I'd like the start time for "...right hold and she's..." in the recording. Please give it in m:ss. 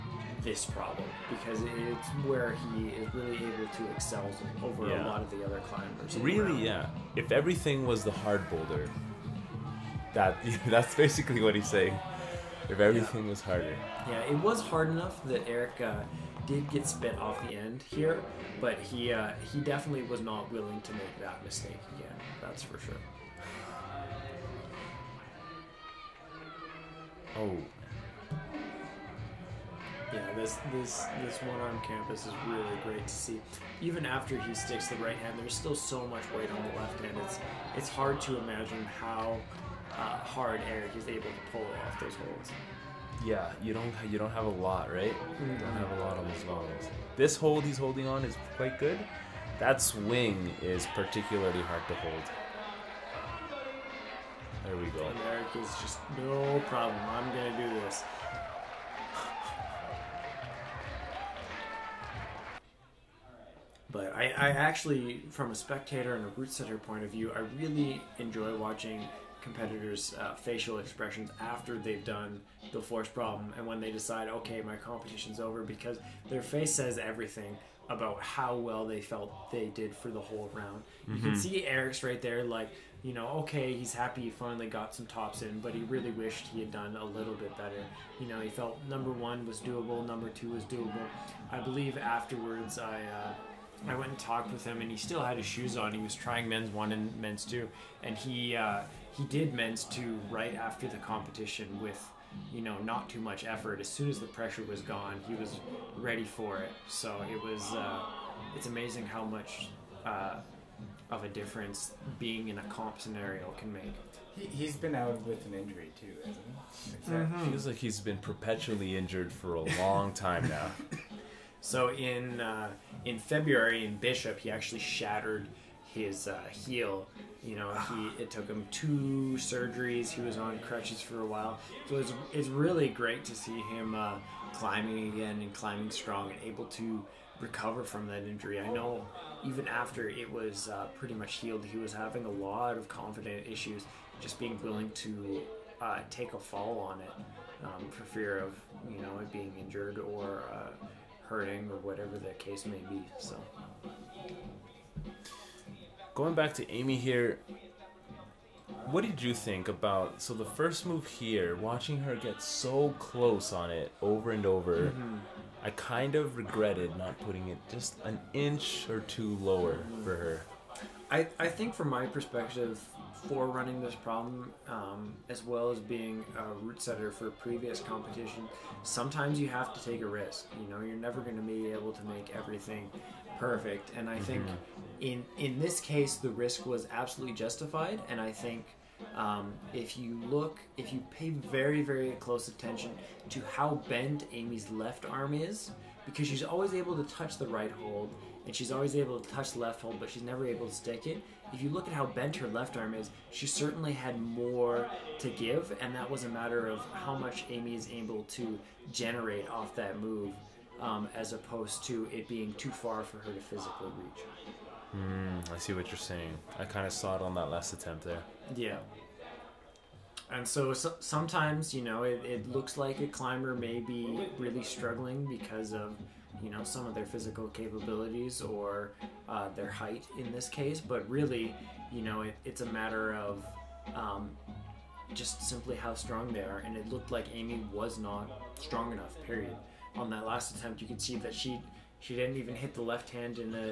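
3:17.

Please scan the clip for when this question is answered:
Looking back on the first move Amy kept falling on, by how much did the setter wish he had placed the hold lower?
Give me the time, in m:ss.
2:48.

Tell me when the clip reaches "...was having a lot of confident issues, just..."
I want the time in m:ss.
2:21.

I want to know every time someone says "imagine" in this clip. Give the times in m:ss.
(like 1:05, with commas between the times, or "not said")
0:38.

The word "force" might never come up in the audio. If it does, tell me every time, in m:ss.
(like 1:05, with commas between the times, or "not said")
1:12.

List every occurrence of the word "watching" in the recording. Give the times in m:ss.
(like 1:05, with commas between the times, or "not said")
1:08, 2:41.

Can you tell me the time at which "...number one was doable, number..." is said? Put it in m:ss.
1:28.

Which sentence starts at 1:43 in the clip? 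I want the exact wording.
As soon as the pressure was gone, he was ready for it.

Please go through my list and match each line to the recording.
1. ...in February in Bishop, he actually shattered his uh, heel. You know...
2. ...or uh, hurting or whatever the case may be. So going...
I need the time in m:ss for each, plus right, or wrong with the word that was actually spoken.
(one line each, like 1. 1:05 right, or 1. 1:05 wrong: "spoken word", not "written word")
1. 2:03 right
2. 2:29 right.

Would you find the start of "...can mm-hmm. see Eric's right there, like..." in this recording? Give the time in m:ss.
1:21.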